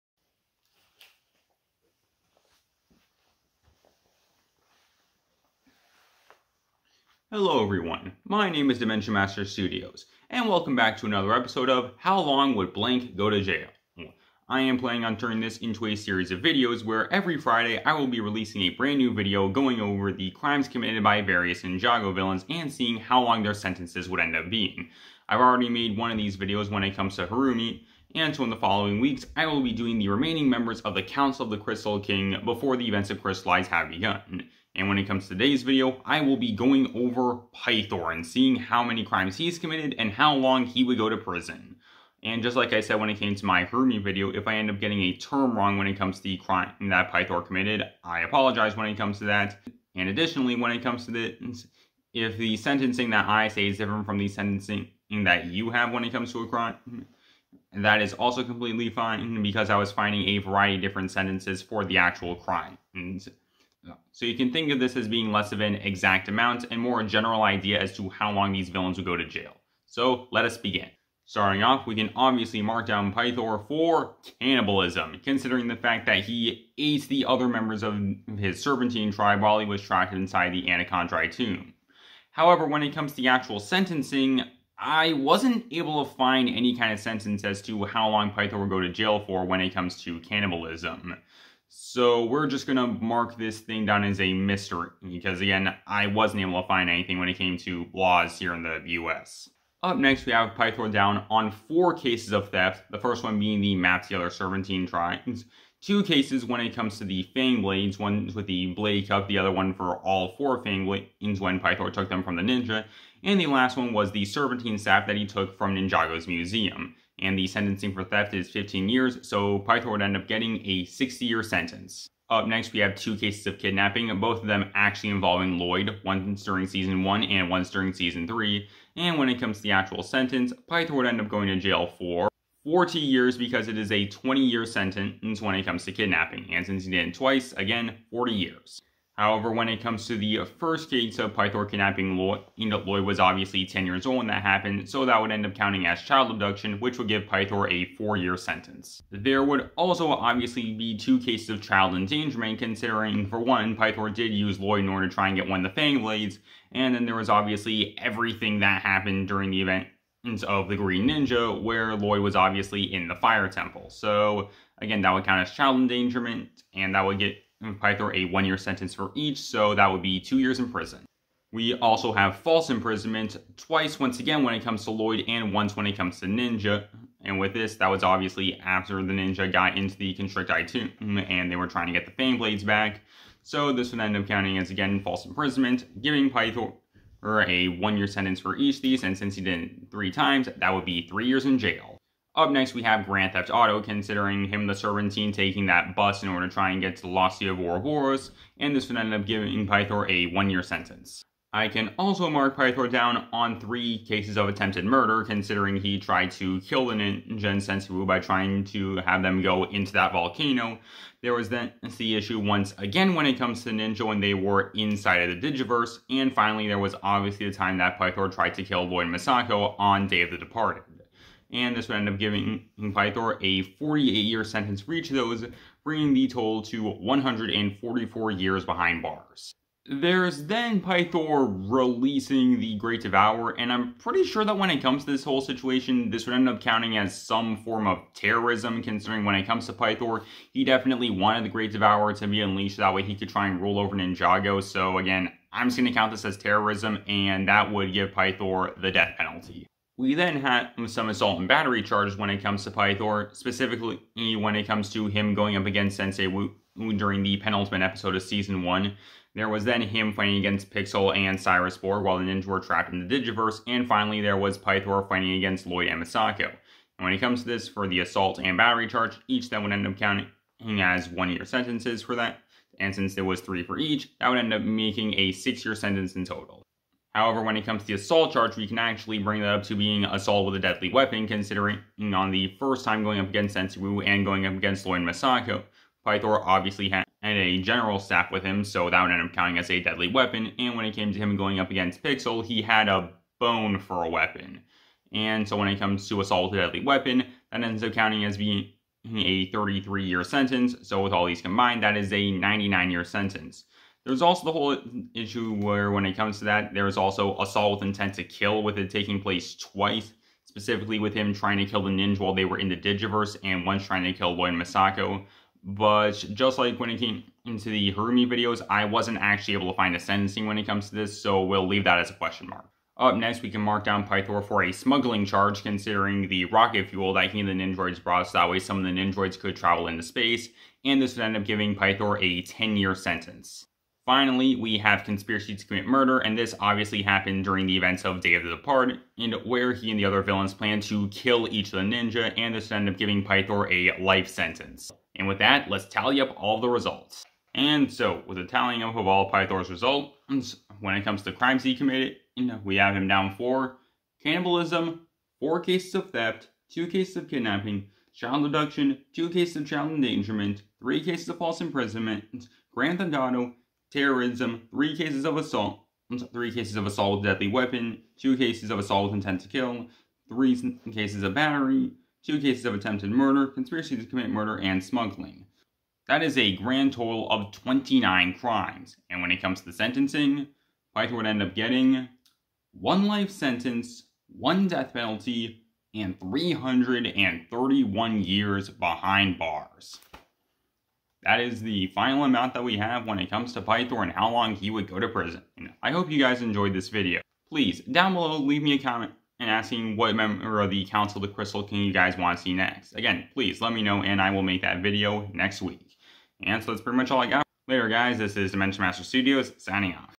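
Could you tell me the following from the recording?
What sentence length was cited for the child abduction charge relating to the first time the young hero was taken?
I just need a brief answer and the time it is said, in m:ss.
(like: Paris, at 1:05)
4 years, at 2:28.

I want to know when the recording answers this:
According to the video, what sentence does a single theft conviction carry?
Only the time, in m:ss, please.
1:58.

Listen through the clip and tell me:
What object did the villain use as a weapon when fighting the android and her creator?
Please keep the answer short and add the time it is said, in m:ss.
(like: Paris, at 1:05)
a bone, at 4:52.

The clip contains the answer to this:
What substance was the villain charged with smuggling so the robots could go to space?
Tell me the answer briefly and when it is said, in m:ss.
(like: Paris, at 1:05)
rocket fuel, at 5:26.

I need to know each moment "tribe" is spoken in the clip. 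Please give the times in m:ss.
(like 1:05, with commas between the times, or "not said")
1:19.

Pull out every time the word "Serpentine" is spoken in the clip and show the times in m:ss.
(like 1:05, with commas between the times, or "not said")
1:18, 1:44, 1:54, 3:14.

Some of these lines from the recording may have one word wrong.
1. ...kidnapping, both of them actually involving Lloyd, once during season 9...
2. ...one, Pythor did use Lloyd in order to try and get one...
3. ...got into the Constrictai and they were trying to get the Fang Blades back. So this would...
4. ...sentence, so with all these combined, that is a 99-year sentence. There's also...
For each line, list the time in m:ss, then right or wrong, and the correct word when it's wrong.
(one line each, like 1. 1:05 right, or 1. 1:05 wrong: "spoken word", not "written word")
1. 2:03 wrong: "1", not "9"
2. 2:33 right
3. 2:59 right
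4. 5:00 right.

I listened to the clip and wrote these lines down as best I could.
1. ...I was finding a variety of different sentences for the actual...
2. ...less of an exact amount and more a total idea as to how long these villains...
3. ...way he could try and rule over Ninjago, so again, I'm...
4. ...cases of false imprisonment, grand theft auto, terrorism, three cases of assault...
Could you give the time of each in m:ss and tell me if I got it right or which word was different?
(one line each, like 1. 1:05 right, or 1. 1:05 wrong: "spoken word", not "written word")
1. 0:59 right
2. 1:05 wrong: "general", not "total"
3. 4:02 right
4. 6:01 right.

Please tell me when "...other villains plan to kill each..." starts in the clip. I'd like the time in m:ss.
5:40.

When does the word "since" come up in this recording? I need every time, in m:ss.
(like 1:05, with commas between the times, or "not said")
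2:16, 3:09, 4:32.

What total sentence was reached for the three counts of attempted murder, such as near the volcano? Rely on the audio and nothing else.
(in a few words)
144 years.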